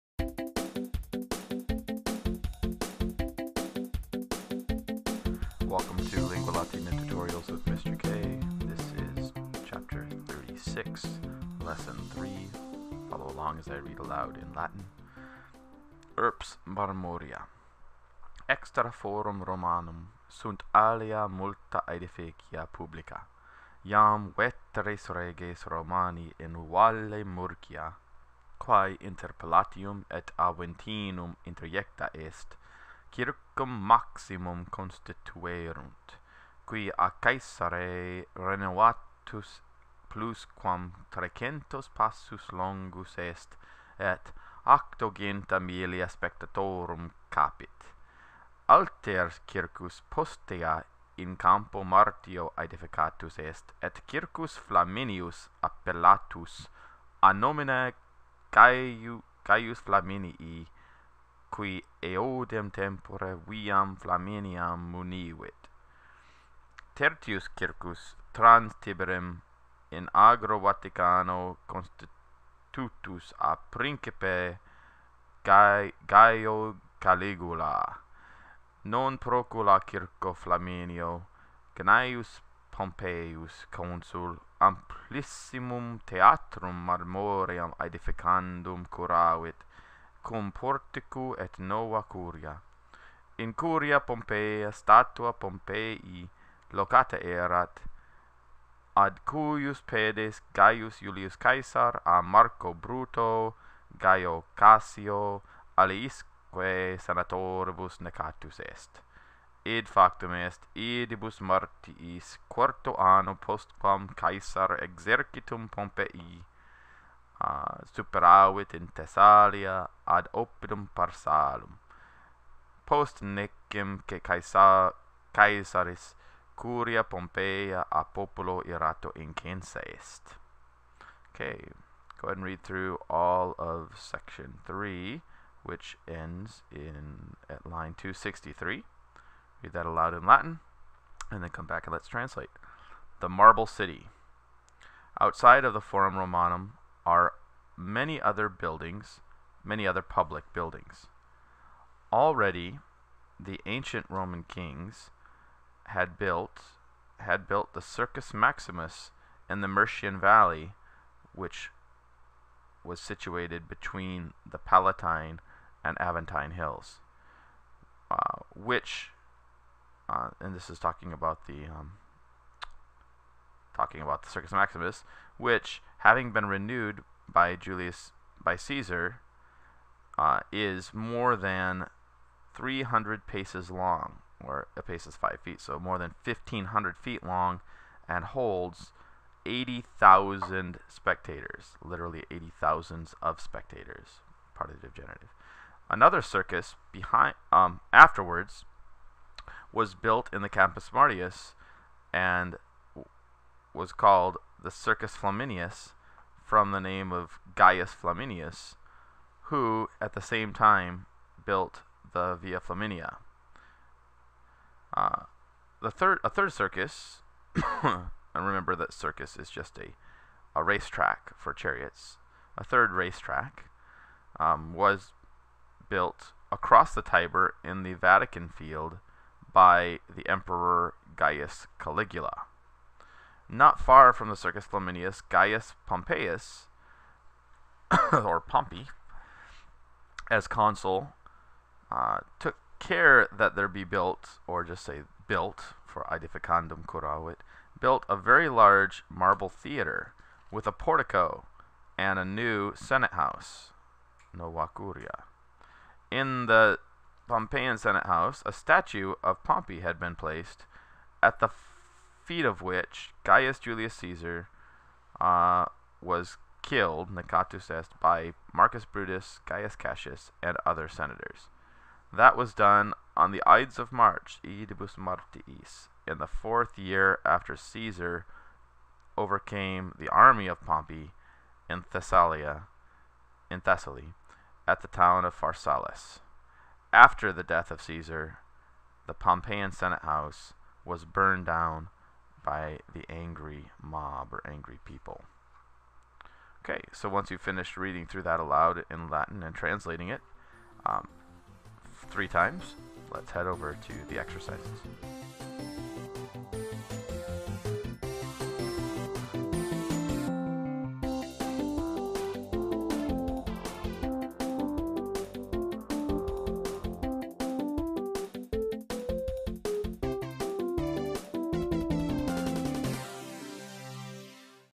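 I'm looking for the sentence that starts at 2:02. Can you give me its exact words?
Post necem che Caesar, Caesaris curia Pompeia a populo irato incensa est.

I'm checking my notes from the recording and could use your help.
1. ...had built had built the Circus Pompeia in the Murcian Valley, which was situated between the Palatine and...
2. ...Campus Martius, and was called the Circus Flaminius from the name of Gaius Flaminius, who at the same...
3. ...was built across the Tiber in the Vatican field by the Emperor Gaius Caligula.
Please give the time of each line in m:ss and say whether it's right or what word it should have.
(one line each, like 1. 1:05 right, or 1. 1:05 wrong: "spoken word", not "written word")
1. 2:35 wrong: "Maximus", not "Pompeia"
2. 3:20 right
3. 3:44 right.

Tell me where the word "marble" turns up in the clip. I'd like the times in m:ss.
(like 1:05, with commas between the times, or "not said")
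2:23, 4:09.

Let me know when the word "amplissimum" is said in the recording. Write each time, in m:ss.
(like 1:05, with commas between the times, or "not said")
1:24.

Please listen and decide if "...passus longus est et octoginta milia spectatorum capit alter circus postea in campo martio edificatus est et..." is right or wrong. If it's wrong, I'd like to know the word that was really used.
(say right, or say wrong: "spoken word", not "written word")
right.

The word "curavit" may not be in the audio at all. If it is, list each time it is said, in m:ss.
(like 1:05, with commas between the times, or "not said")
1:28, 4:06.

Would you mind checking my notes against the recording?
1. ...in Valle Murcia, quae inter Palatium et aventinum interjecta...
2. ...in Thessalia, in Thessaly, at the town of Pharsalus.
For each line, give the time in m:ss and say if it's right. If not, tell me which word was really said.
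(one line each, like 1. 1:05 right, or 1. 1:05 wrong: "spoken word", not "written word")
1. 0:26 right
2. 4:41 right.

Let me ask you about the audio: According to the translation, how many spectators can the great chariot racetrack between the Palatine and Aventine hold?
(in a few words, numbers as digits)
80,000.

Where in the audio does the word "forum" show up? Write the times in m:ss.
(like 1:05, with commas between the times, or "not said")
0:18, 2:25.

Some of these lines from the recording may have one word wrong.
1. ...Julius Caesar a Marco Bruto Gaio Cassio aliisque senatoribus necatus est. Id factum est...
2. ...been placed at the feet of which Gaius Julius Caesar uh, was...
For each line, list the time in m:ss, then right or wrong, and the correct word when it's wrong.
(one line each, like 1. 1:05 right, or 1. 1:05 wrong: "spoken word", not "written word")
1. 1:40 right
2. 4:19 right.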